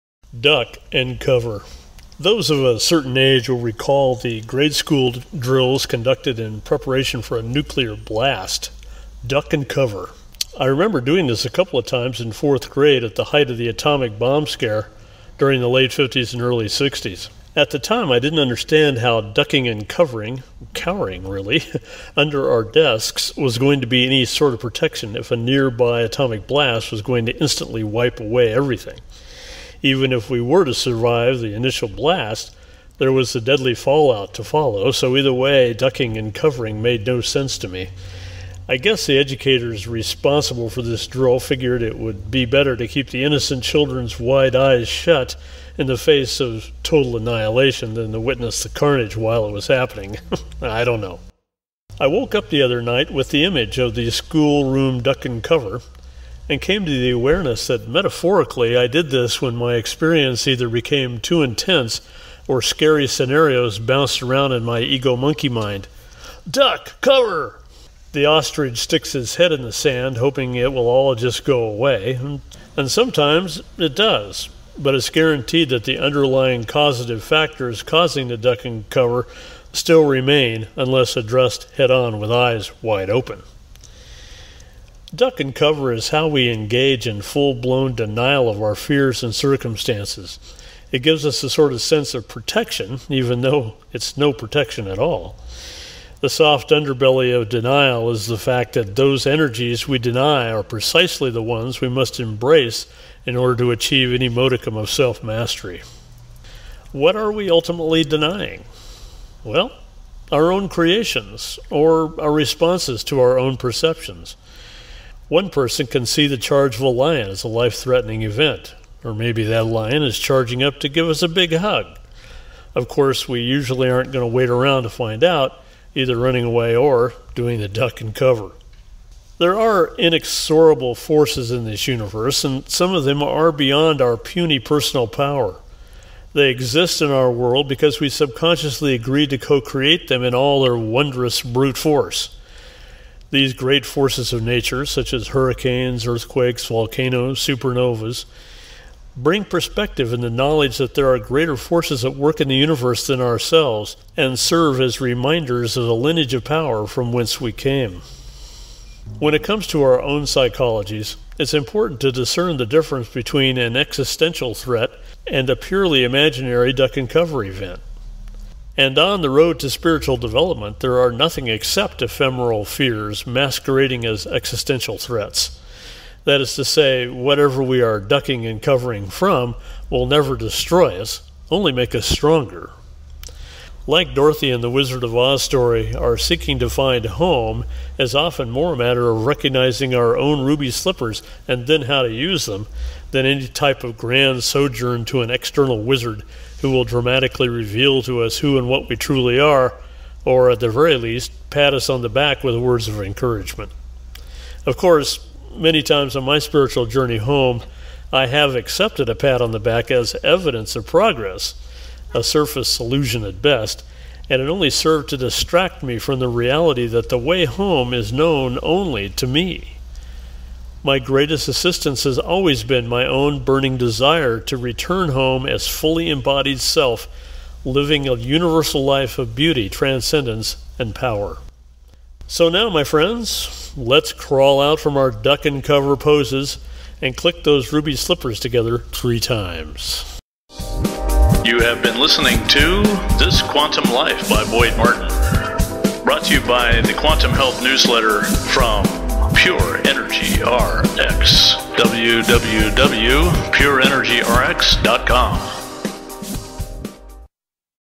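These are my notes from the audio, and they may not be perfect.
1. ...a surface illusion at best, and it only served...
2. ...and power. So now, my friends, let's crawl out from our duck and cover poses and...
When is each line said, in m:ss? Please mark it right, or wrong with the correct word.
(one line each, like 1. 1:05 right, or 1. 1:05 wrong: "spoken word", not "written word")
1. 3:32 right
2. 3:50 right.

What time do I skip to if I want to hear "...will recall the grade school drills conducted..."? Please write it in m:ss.
0:03.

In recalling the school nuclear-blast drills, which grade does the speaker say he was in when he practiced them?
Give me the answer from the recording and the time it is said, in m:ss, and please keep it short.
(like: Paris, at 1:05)
fourth grade, at 0:12.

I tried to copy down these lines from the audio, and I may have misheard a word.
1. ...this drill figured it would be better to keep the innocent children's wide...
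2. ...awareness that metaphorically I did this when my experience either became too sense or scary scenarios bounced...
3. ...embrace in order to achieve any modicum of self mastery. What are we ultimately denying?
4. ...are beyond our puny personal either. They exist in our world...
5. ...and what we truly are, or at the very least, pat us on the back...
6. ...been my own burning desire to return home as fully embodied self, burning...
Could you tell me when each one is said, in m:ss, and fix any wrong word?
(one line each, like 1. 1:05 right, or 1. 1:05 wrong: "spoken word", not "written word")
1. 0:40 right
2. 0:57 wrong: "intense", not "sense"
3. 1:42 right
4. 2:13 wrong: "power", not "either"
5. 3:18 right
6. 3:42 wrong: "living", not "burning".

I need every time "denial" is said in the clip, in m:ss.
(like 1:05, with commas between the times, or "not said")
1:27, 1:37.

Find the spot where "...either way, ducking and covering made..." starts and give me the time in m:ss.
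0:35.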